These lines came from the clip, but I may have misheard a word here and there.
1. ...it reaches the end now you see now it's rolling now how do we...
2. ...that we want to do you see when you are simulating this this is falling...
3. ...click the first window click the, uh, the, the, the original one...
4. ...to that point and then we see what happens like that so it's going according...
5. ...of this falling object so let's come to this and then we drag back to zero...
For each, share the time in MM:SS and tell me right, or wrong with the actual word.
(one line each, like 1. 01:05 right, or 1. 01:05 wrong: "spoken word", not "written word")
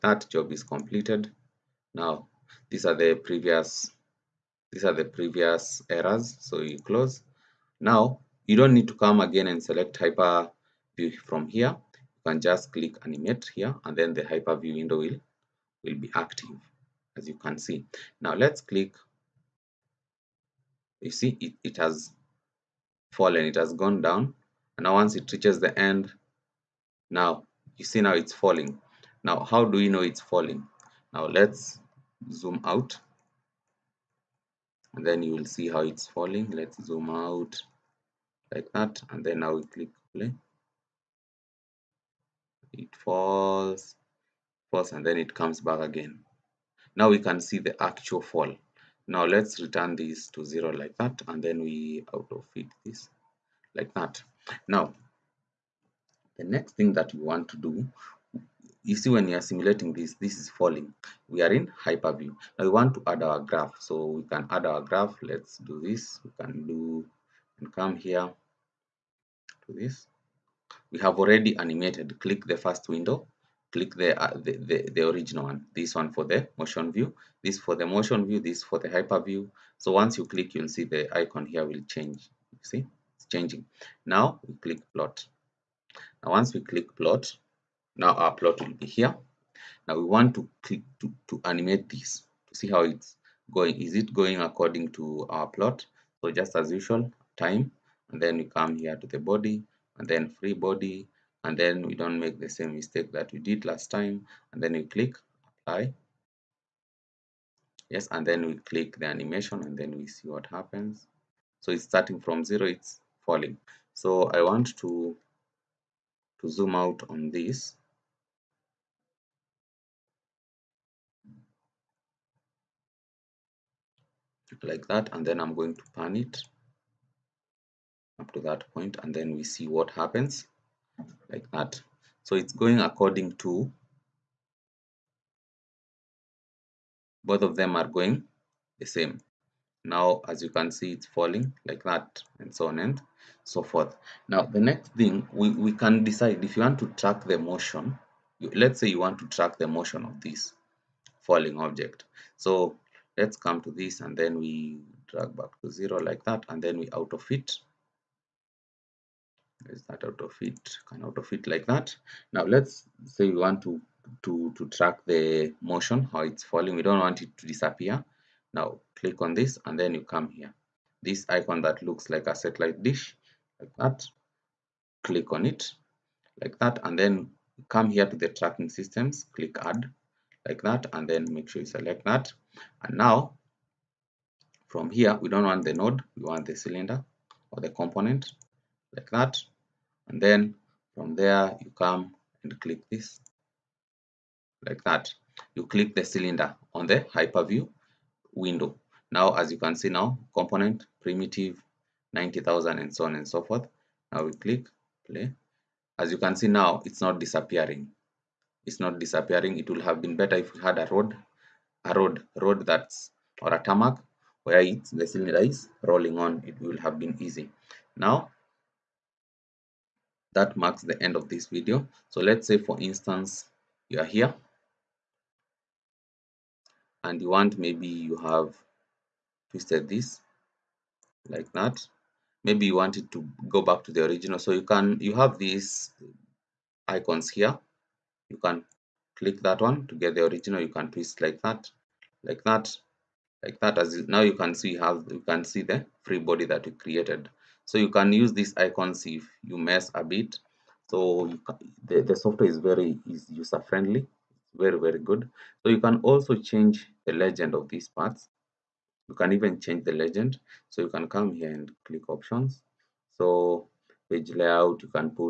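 1. 00:25 wrong: "falling", not "rolling"
2. 00:56 right
3. 01:12 right
4. 02:08 right
5. 02:30 right.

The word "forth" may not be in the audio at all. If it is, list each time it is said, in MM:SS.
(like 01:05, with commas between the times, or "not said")
02:23, 03:23.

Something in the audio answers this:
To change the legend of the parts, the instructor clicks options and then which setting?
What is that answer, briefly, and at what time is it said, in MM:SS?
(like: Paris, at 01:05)
Page layout, at 04:24.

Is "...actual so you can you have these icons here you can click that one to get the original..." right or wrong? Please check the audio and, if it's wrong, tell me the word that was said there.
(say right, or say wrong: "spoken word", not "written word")
wrong: "original", not "actual".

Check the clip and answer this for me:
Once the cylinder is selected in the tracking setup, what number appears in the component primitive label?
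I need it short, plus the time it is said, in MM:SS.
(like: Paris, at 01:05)
90,000, at 03:22.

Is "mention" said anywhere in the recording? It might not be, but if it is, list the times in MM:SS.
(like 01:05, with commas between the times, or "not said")
not said.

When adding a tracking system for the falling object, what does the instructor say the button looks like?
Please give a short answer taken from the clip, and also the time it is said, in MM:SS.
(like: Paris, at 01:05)
Satellite dish, at 02:52.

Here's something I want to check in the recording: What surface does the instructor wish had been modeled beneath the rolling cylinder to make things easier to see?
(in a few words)
A tarmac.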